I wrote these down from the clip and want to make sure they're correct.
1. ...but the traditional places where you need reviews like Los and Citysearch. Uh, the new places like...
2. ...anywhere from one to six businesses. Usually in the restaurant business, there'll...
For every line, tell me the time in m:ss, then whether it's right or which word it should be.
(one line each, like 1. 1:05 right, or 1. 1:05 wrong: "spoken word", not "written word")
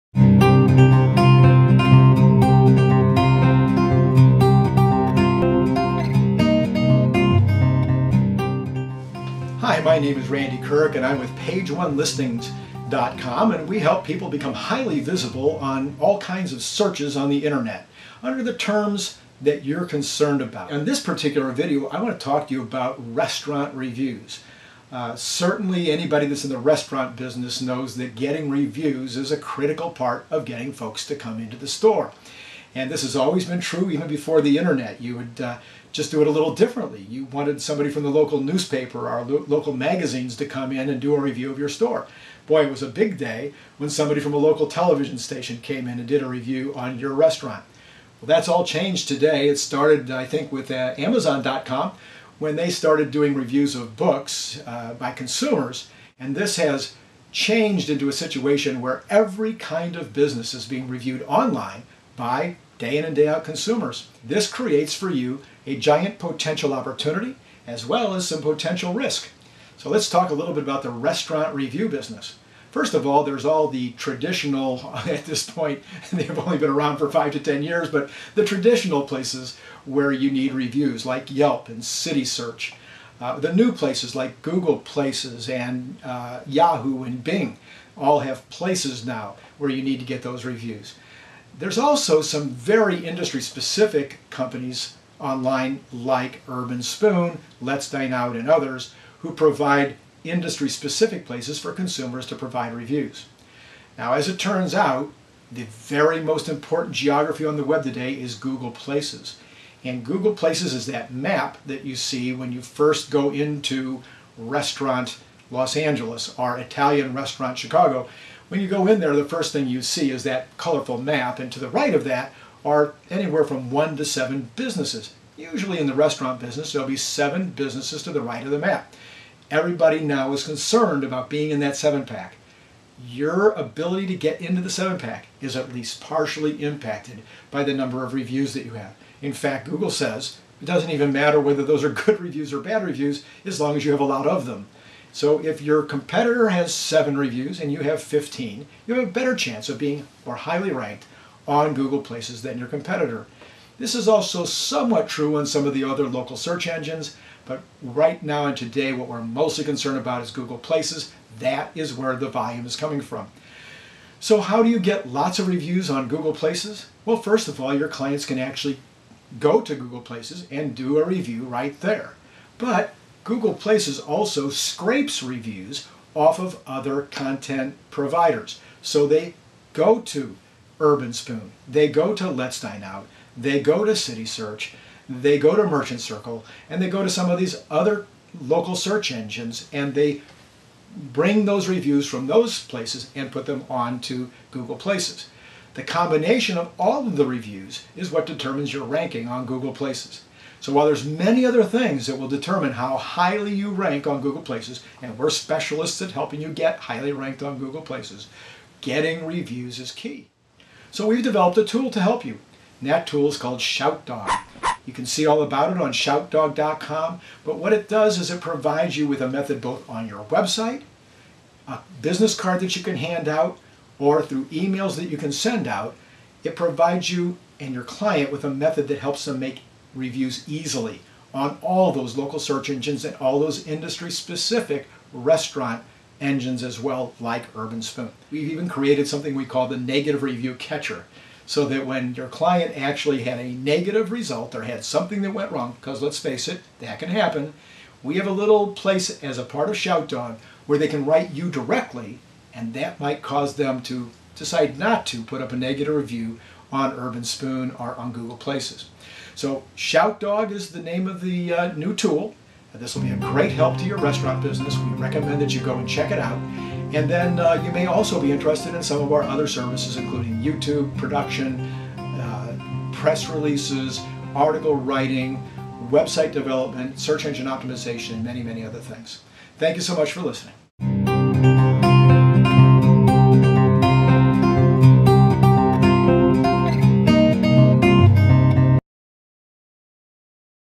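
1. 1:17 wrong: "Yelp", not "Los"
2. 2:03 wrong: "seven", not "six".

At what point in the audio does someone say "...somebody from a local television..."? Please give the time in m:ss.
0:43.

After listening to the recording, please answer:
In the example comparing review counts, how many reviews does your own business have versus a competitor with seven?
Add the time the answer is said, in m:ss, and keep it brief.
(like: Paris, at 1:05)
15, at 2:28.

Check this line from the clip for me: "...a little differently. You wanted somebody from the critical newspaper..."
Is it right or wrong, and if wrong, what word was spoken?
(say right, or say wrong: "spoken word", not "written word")
wrong: "local", not "critical".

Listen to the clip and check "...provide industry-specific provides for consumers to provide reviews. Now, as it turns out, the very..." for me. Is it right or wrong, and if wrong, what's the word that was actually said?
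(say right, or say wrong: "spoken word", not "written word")
wrong: "places", not "provides".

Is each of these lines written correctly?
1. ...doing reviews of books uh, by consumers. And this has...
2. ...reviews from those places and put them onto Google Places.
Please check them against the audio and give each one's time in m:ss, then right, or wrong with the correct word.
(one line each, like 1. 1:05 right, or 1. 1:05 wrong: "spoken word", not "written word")
1. 0:53 right
2. 3:11 right.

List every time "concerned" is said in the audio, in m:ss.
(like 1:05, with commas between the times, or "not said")
0:19, 2:10, 2:39.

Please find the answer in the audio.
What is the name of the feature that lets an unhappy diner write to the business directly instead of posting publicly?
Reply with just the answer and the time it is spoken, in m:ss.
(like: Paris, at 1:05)
negative review catcher, at 3:59.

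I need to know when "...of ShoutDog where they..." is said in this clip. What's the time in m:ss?
4:09.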